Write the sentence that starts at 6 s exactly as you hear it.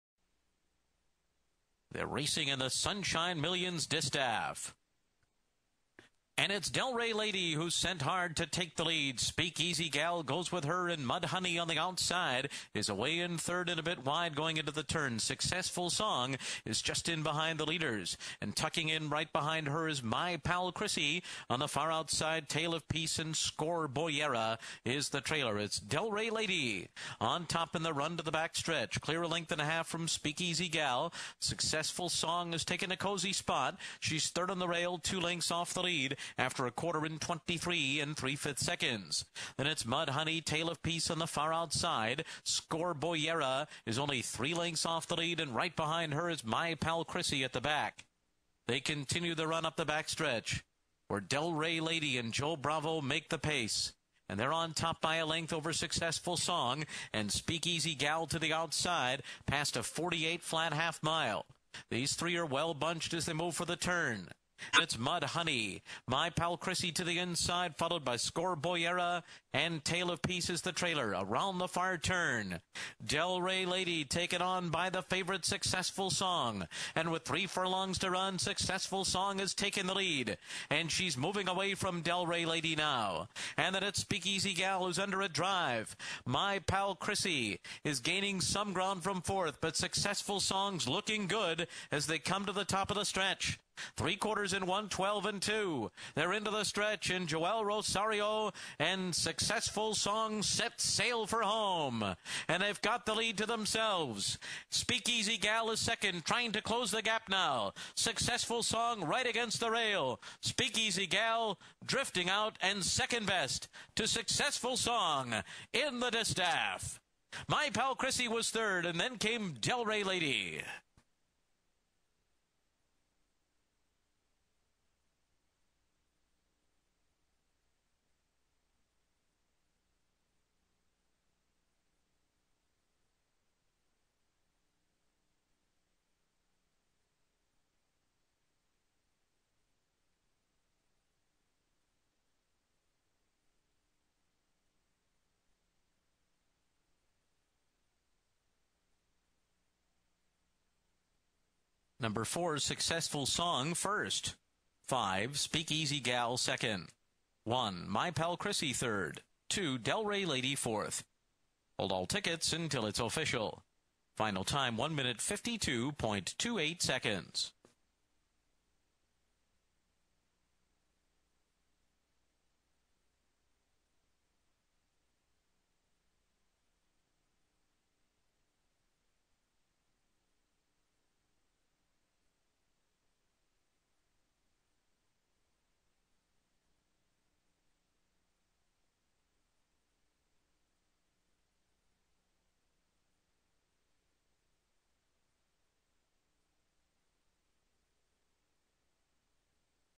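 And it's Delray Lady who's sent hard to take the lead.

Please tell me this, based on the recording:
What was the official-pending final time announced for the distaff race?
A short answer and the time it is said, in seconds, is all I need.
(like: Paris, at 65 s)
1 minute 52.28 seconds, at 164 s.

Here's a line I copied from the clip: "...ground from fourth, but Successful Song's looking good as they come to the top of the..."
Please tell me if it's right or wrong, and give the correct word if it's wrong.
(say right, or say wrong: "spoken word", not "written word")
right.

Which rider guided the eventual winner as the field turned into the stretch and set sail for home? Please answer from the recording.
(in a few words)
Joel Rosario.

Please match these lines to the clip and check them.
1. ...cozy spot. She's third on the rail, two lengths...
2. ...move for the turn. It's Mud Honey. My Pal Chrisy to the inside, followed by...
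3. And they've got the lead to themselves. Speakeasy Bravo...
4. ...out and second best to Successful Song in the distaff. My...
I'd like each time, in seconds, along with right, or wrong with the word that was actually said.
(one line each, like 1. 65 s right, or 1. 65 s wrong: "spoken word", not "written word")
1. 32 s right
2. 63 s right
3. 102 s wrong: "Gal", not "Bravo"
4. 112 s right.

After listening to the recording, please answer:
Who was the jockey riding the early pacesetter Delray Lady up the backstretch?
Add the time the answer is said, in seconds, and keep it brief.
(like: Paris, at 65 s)
Joe Bravo, at 52 s.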